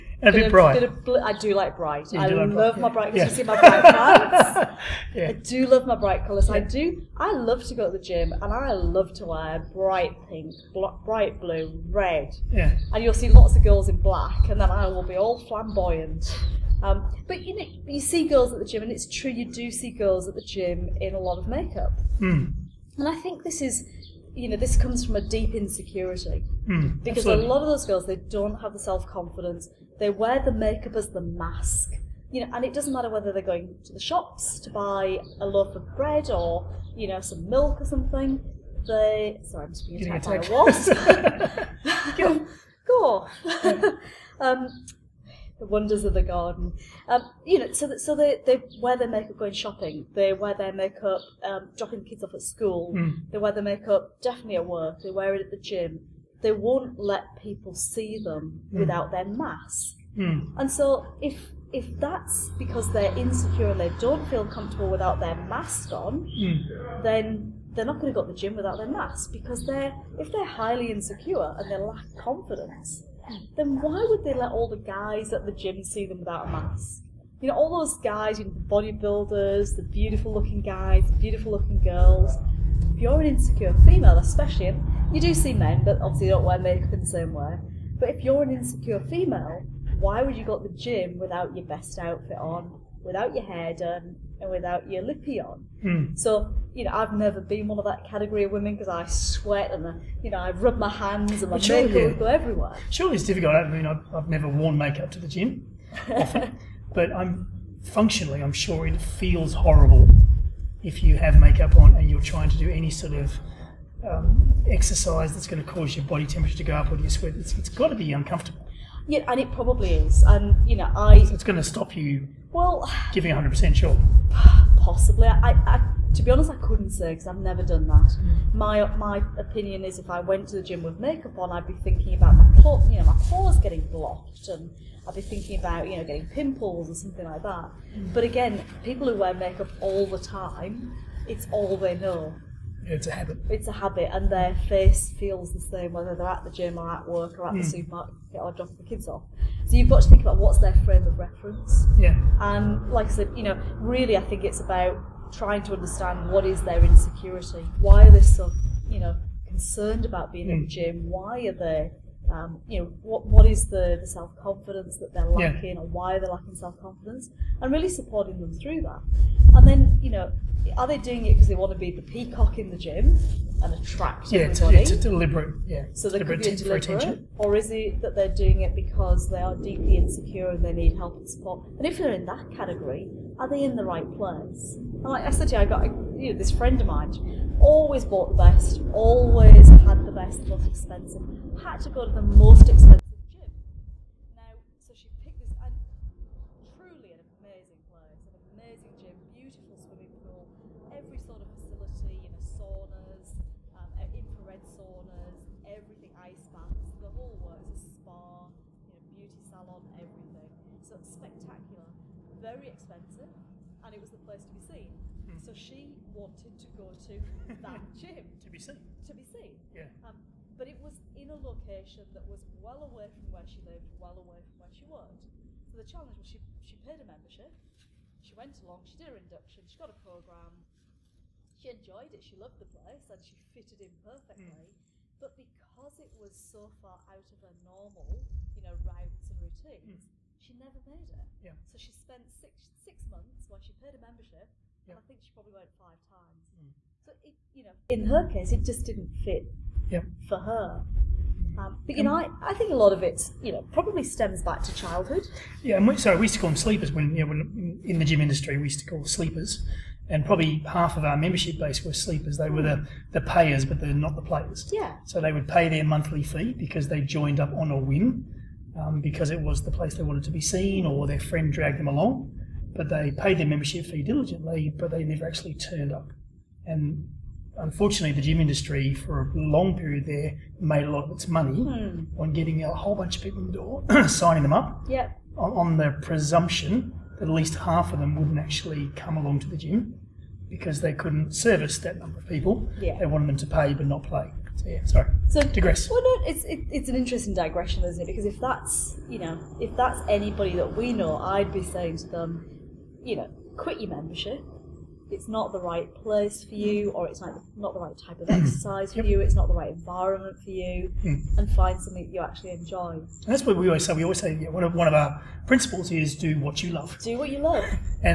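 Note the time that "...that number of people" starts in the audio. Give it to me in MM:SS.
04:51.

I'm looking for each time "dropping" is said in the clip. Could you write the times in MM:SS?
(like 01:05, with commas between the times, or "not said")
00:51, 02:28.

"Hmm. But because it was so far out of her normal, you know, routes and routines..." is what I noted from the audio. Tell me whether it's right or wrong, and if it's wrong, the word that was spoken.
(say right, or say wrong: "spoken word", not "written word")
right.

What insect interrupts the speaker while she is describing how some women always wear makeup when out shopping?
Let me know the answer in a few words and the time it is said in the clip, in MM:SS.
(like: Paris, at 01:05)
A wasp, at 00:40.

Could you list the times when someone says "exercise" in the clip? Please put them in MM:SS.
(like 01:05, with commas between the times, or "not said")
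01:54, 05:08.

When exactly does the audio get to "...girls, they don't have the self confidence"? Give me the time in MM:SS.
00:27.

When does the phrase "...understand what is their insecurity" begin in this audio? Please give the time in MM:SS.
02:35.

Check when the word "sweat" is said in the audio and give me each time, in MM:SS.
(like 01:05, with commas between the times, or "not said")
01:39, 01:57.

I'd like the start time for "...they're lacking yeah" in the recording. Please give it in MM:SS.
02:45.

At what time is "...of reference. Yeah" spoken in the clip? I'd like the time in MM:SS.
02:31.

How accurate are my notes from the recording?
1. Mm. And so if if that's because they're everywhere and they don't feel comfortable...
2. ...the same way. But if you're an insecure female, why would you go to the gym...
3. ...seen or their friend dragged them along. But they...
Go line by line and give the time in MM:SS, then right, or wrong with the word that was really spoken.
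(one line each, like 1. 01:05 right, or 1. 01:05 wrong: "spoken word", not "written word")
1. 01:00 wrong: "insecure", not "everywhere"
2. 01:27 right
3. 04:30 right.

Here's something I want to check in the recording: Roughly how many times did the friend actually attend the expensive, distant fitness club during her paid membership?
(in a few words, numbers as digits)
5.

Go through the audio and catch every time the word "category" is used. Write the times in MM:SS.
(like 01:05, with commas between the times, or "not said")
01:38, 03:02.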